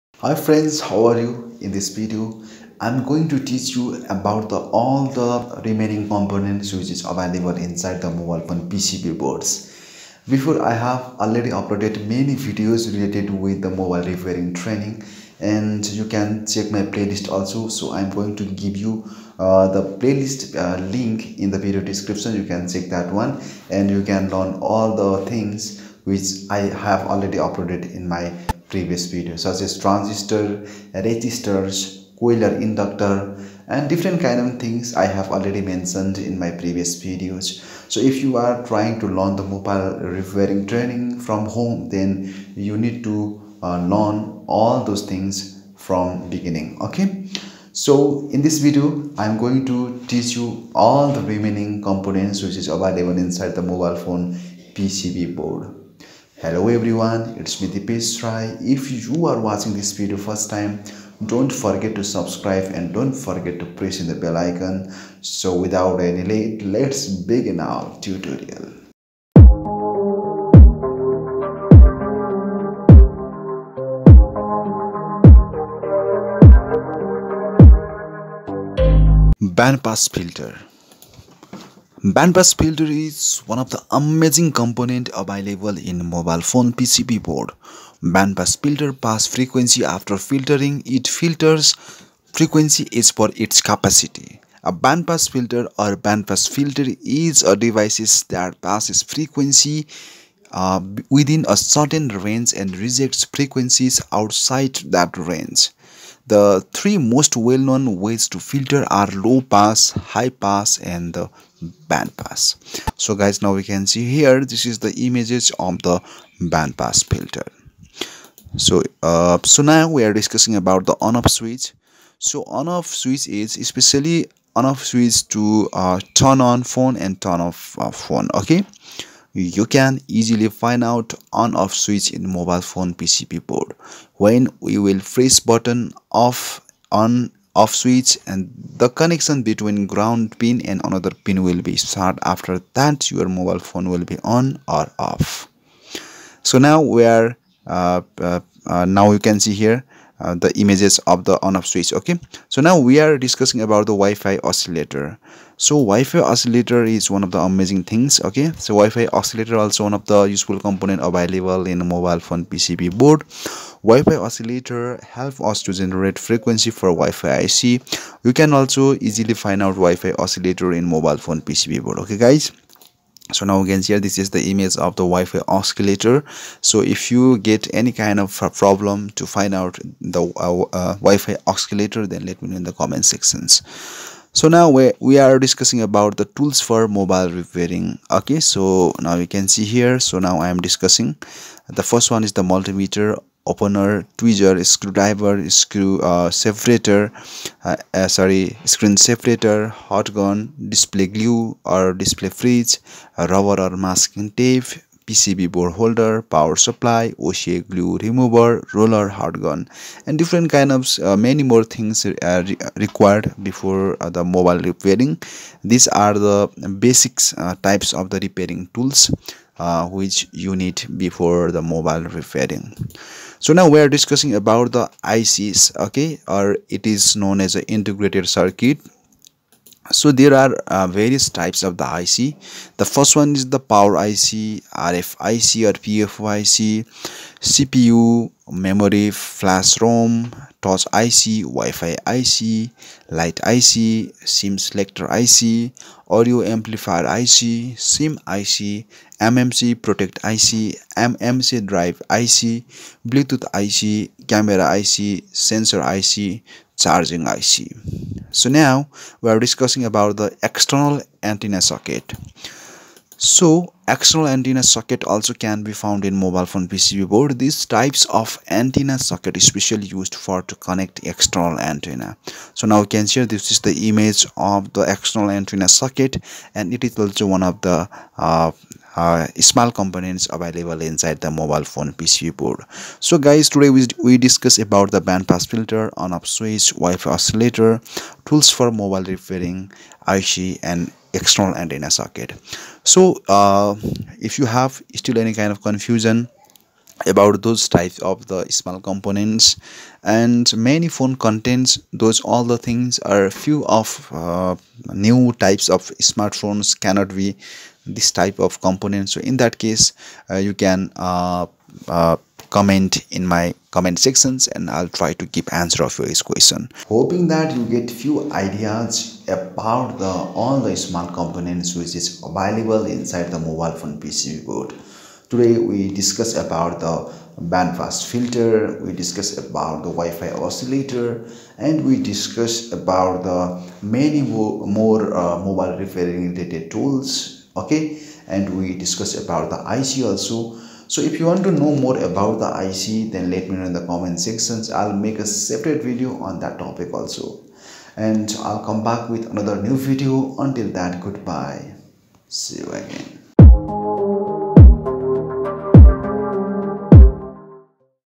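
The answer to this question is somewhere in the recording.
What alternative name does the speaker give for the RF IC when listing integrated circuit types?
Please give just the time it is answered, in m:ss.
3:55.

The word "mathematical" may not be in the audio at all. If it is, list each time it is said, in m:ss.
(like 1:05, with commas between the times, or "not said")
not said.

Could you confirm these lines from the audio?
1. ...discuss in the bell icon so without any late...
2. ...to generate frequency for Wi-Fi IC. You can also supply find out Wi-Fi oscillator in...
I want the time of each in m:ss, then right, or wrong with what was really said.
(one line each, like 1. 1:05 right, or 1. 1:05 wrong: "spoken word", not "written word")
1. 1:03 wrong: "press", not "discuss"
2. 2:45 wrong: "easily", not "supply".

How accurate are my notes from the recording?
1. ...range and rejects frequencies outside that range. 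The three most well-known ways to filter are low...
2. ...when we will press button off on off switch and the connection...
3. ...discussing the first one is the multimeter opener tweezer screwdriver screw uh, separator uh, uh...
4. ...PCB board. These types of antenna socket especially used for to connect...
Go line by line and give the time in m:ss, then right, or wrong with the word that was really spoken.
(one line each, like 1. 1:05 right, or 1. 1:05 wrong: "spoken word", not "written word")
1. 1:42 right
2. 2:14 right
3. 3:10 right
4. 4:26 right.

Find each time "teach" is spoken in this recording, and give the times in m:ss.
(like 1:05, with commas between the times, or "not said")
0:03, 0:50.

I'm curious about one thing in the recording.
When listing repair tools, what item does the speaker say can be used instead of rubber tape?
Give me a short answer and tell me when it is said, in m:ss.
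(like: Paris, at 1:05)
Masking tape, at 3:23.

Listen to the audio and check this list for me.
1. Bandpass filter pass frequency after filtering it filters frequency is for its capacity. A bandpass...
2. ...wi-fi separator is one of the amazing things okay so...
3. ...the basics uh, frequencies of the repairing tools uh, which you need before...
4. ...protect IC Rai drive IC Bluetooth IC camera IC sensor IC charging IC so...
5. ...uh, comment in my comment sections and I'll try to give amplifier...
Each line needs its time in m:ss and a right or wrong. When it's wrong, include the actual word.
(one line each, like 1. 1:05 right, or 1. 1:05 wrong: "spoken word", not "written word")
1. 1:28 right
2. 2:35 wrong: "oscillator", not "separator"
3. 3:36 wrong: "types", not "frequencies"
4. 4:09 wrong: "MMC", not "Rai"
5. 5:11 wrong: "answer", not "amplifier".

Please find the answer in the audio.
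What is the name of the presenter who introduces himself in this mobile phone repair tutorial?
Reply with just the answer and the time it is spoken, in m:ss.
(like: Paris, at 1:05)
Dipesh Rai, at 0:57.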